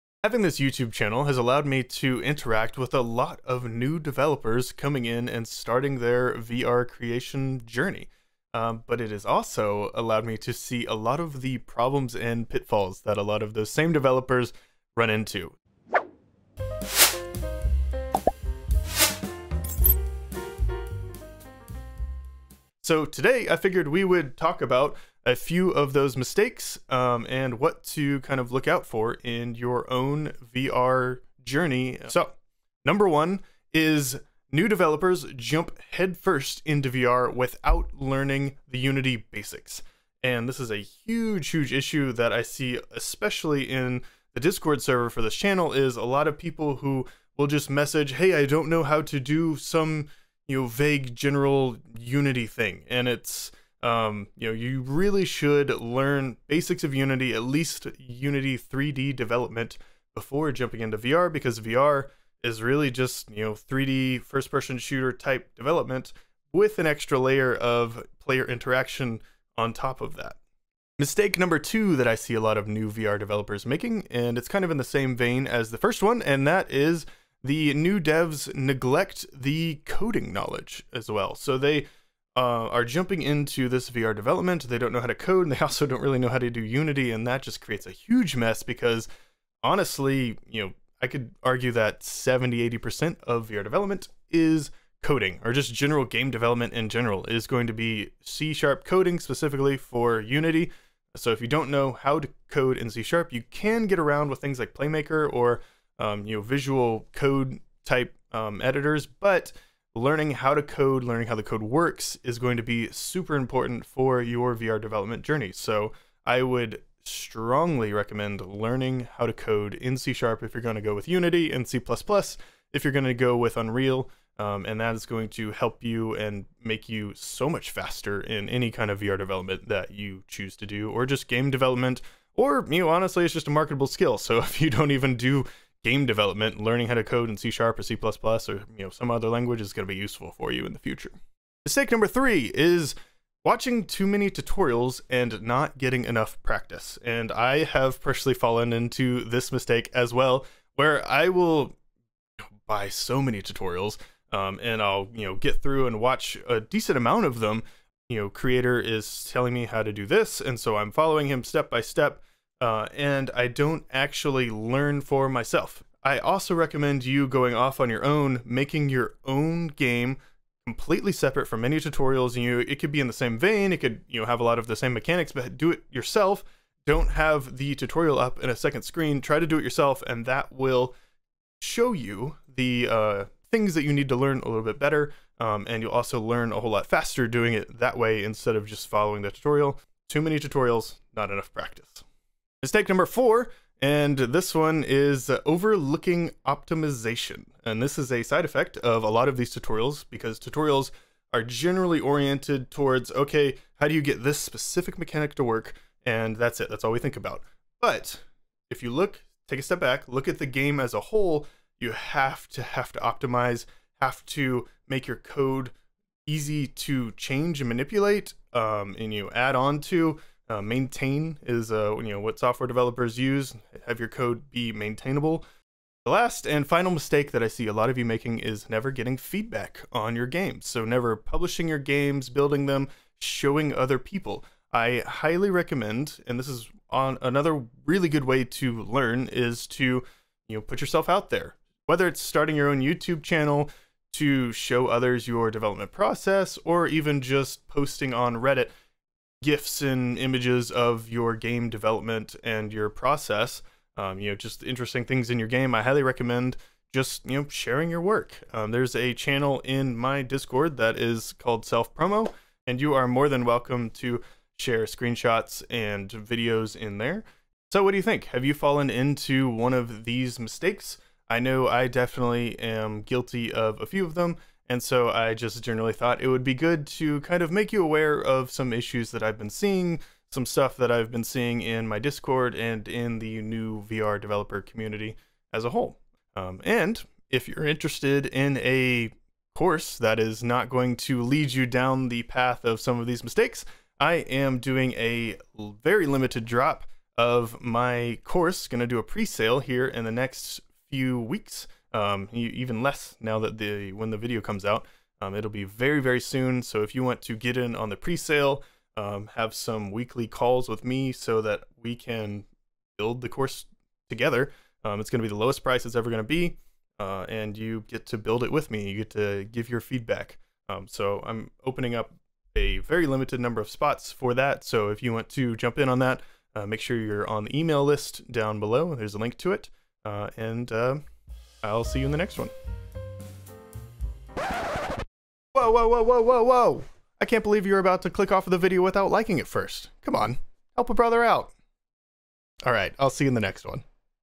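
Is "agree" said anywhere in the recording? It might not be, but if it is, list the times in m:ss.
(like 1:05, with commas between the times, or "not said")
not said.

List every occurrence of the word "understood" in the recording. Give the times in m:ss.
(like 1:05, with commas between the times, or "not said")
not said.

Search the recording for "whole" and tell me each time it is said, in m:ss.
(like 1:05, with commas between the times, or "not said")
3:06, 3:30, 4:45.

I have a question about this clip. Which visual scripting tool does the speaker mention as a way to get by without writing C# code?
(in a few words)
Playmaker.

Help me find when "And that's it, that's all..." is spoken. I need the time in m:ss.
3:26.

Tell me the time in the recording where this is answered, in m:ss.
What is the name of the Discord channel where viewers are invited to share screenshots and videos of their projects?
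4:21.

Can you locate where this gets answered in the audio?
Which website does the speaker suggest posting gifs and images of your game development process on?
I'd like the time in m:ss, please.
4:08.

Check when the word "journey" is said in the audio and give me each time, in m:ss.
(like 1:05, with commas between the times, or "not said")
0:07, 0:31, 1:55.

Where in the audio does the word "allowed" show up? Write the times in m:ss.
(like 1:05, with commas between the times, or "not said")
0:01, 0:09.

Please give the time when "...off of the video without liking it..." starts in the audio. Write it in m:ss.
5:38.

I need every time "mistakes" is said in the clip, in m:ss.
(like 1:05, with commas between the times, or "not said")
0:26, 1:10, 2:21, 2:29, 3:12, 3:46, 4:30, 4:53.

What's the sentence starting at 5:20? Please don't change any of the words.
Um, so I'm opening up a very limited number of spots for that.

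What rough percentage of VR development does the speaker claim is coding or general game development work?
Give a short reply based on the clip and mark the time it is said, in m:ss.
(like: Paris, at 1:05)
70-80%, at 1:32.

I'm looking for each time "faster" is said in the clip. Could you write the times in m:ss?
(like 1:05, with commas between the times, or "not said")
2:07, 3:06.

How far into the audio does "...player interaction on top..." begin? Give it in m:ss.
1:08.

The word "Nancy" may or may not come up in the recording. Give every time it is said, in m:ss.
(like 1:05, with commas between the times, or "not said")
not said.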